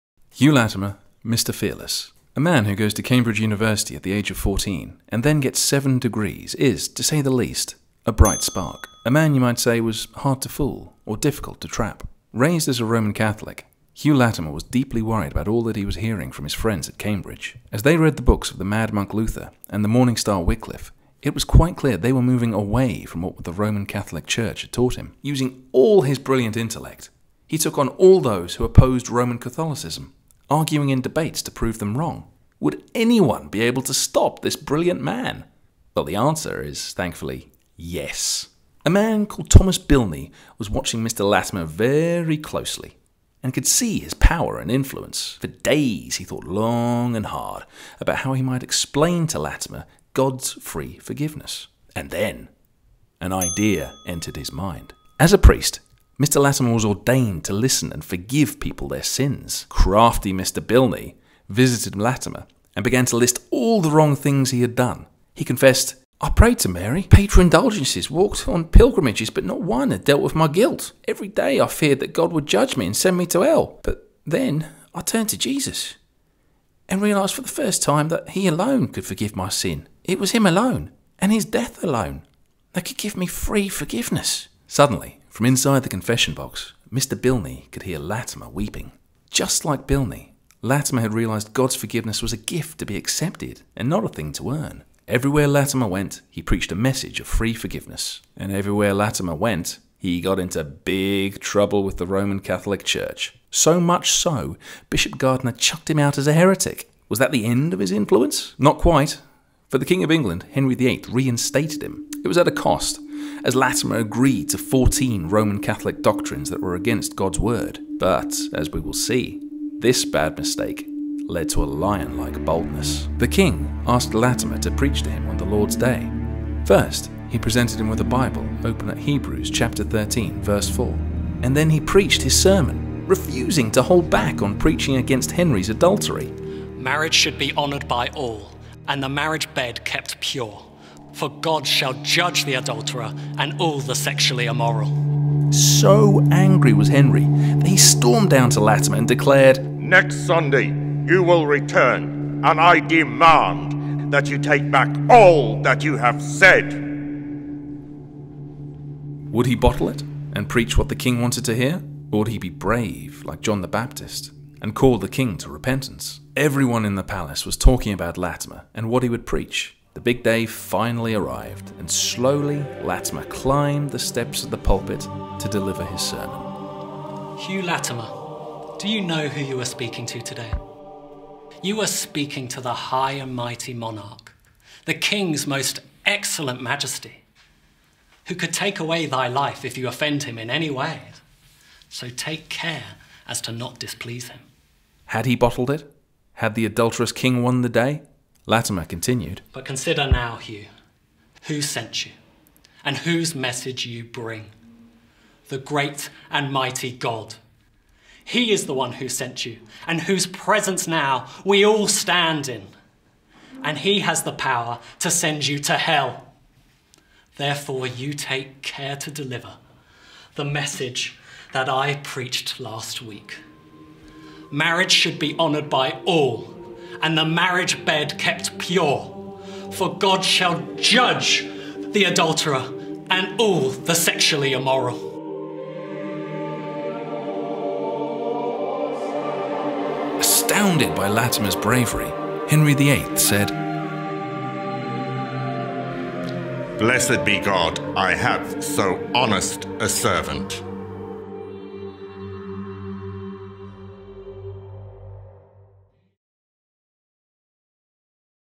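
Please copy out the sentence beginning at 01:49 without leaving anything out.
For the King of England, Henry VIII reinstated him.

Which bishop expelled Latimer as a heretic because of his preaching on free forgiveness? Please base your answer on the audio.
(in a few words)
Bishop Gardiner.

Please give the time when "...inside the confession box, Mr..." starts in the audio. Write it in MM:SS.
01:25.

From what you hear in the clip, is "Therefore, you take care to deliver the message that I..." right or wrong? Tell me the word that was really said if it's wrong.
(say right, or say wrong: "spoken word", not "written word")
right.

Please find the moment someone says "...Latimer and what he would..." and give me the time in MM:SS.
02:48.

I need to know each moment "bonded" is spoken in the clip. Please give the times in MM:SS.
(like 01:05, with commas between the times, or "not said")
not said.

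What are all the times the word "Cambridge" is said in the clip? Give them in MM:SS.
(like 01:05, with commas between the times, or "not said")
00:03, 00:16.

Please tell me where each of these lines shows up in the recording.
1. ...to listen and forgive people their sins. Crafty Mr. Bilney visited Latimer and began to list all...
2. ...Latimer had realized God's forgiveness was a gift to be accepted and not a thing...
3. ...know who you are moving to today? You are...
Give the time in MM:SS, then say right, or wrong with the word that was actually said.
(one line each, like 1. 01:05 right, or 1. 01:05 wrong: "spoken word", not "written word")
1. 00:57 right
2. 01:30 right
3. 02:59 wrong: "speaking", not "moving".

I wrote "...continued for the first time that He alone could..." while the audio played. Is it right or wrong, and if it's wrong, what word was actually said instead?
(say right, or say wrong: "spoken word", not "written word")
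wrong: "realised", not "continued".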